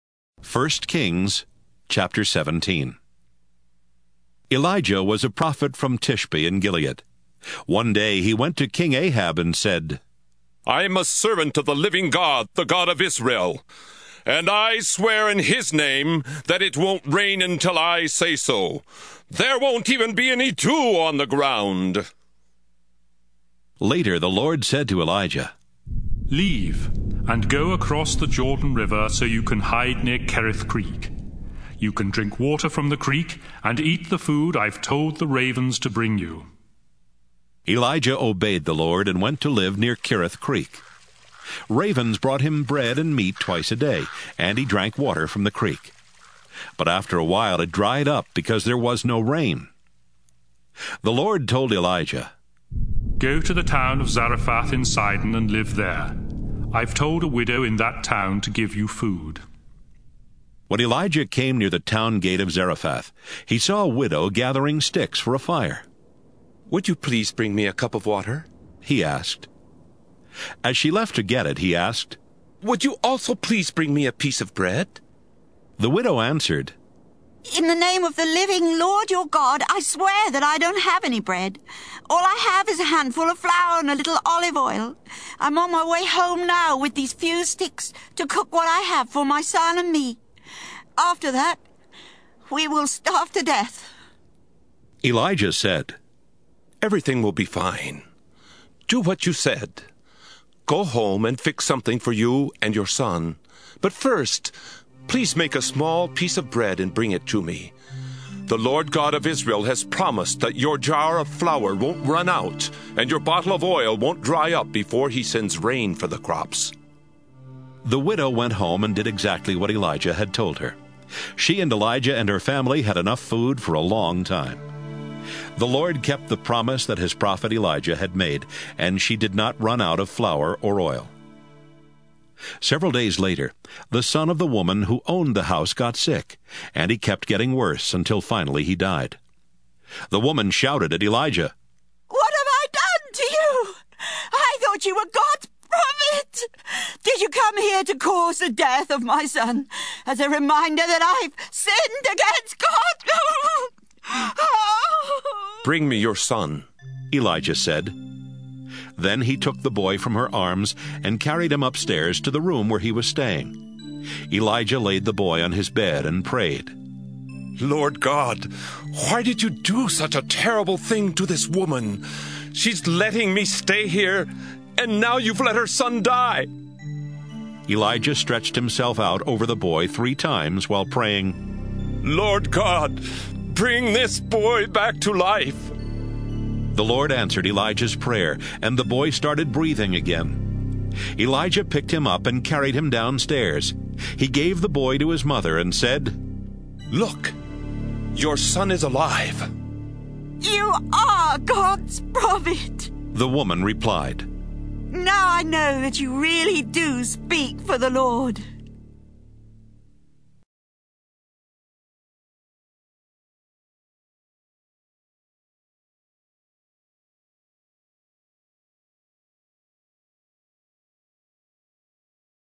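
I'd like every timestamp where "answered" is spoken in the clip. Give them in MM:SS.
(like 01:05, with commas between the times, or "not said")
01:16, 03:07.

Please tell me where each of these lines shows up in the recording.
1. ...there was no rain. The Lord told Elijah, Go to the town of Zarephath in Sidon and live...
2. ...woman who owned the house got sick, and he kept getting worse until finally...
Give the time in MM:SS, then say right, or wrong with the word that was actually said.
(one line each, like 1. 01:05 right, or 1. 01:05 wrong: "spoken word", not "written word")
1. 00:48 right
2. 02:14 right.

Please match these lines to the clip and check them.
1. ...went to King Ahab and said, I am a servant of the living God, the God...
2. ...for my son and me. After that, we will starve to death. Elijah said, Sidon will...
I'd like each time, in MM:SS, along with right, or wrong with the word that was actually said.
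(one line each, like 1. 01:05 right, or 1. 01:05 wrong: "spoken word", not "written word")
1. 00:08 right
2. 01:29 wrong: "Everything", not "Sidon".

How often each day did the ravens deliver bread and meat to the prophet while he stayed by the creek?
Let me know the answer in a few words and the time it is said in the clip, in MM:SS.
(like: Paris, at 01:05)
Twice a day, at 00:43.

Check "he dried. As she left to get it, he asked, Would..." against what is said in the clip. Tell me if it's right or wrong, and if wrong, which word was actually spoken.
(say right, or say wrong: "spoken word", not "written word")
wrong: "asked", not "dried".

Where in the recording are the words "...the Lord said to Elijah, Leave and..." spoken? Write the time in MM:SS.
00:24.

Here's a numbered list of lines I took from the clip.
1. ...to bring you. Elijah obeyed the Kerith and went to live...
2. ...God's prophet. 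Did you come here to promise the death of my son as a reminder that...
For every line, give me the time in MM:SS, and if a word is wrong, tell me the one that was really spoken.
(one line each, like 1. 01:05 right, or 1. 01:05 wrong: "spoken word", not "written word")
1. 00:35 wrong: "Lord", not "Kerith"
2. 02:25 wrong: "cause", not "promise".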